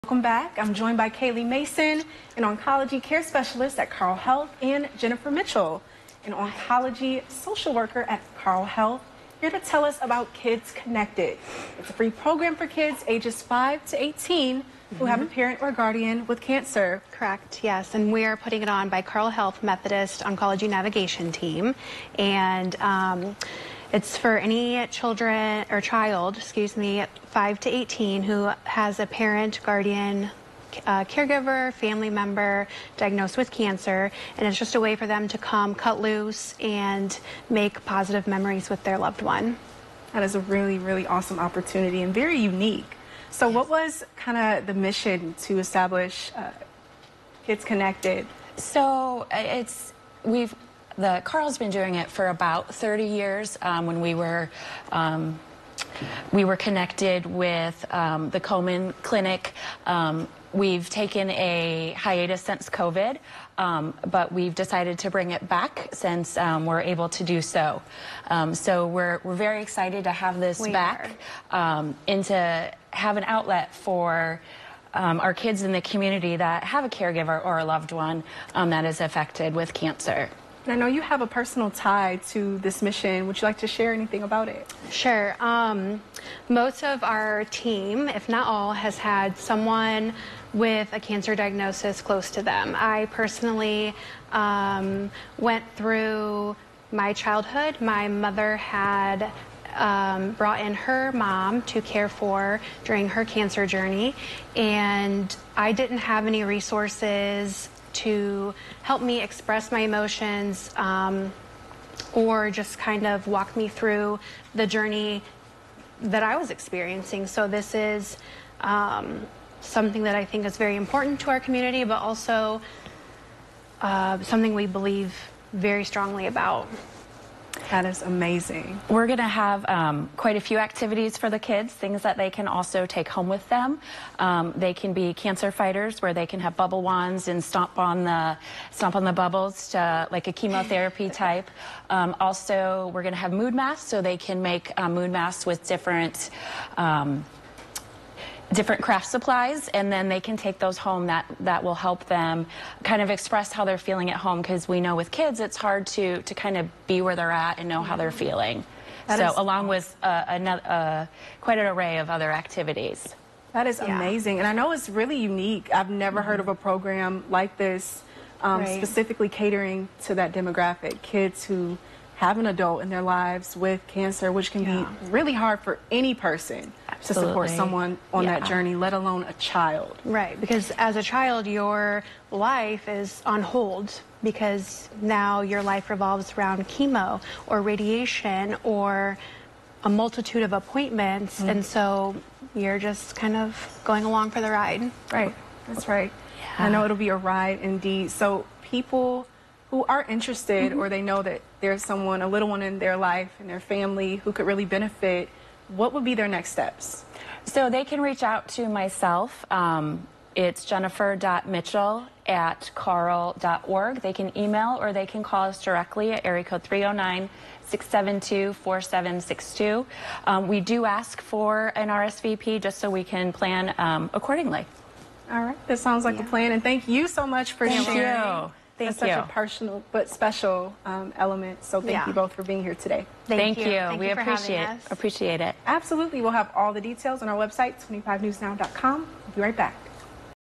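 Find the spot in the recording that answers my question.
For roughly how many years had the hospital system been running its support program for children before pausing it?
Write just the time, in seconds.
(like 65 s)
52 s.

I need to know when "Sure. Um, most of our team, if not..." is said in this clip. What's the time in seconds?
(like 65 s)
84 s.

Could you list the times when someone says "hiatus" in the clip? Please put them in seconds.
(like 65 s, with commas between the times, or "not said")
61 s.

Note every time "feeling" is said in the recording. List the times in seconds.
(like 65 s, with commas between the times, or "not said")
153 s, 158 s.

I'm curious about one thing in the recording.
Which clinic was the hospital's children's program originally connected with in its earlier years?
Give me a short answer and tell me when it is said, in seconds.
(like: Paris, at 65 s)
Komen Clinic, at 58 s.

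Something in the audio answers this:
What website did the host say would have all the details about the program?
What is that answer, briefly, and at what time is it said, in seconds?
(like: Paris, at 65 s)
25newsnow.com, at 237 s.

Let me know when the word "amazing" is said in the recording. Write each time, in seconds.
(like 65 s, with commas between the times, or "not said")
128 s, 163 s.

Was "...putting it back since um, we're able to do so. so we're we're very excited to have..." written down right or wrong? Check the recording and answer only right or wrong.
wrong.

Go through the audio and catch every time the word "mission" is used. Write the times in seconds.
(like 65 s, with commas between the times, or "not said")
44 s, 82 s.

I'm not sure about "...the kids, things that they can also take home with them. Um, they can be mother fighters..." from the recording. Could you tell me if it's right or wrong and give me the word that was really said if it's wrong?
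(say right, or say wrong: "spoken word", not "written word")
wrong: "cancer", not "mother".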